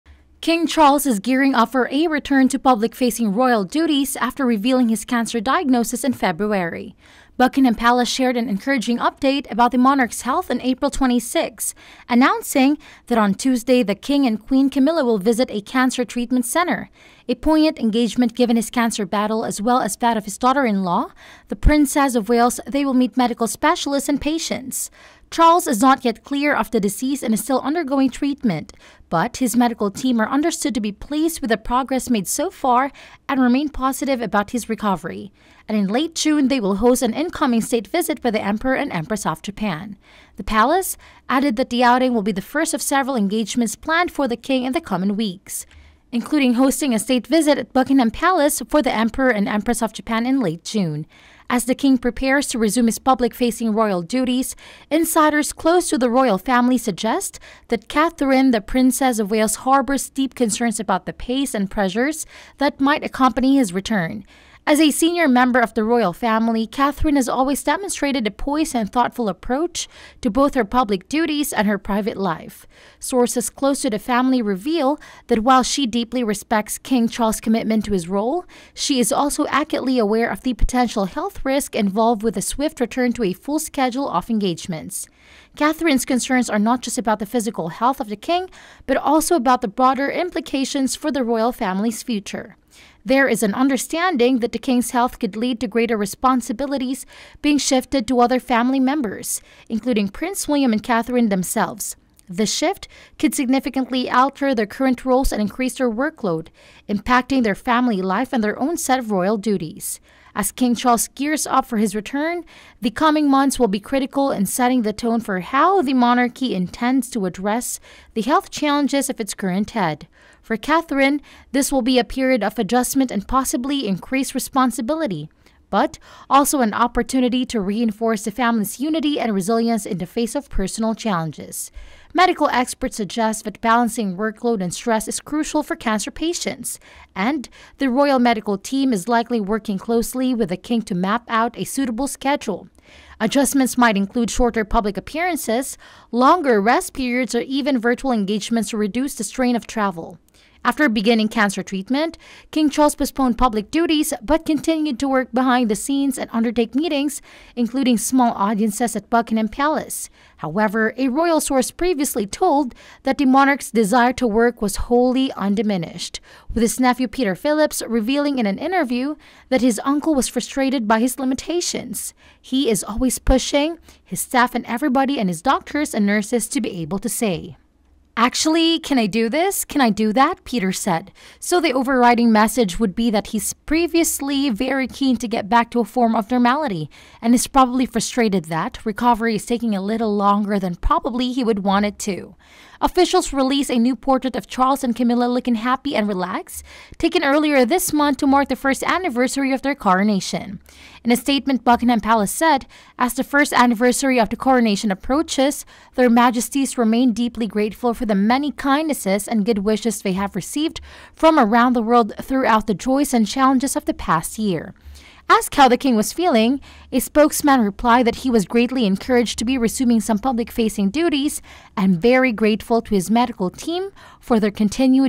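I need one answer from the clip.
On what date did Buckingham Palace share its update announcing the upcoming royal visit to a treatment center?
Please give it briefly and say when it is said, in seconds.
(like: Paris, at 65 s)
April 26, at 10 s.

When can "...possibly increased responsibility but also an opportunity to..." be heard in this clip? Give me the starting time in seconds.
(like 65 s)
123 s.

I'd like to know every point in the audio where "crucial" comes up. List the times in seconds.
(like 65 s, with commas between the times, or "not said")
135 s.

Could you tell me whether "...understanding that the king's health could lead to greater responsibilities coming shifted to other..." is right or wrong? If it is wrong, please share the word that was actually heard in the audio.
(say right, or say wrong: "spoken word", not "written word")
wrong: "being", not "coming".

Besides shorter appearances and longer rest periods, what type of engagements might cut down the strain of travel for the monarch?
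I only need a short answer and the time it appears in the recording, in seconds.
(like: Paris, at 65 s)
Virtual engagements, at 147 s.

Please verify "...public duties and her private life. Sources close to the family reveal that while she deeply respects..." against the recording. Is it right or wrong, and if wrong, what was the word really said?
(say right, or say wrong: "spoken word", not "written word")
right.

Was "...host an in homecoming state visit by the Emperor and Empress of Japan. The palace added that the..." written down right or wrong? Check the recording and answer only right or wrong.
right.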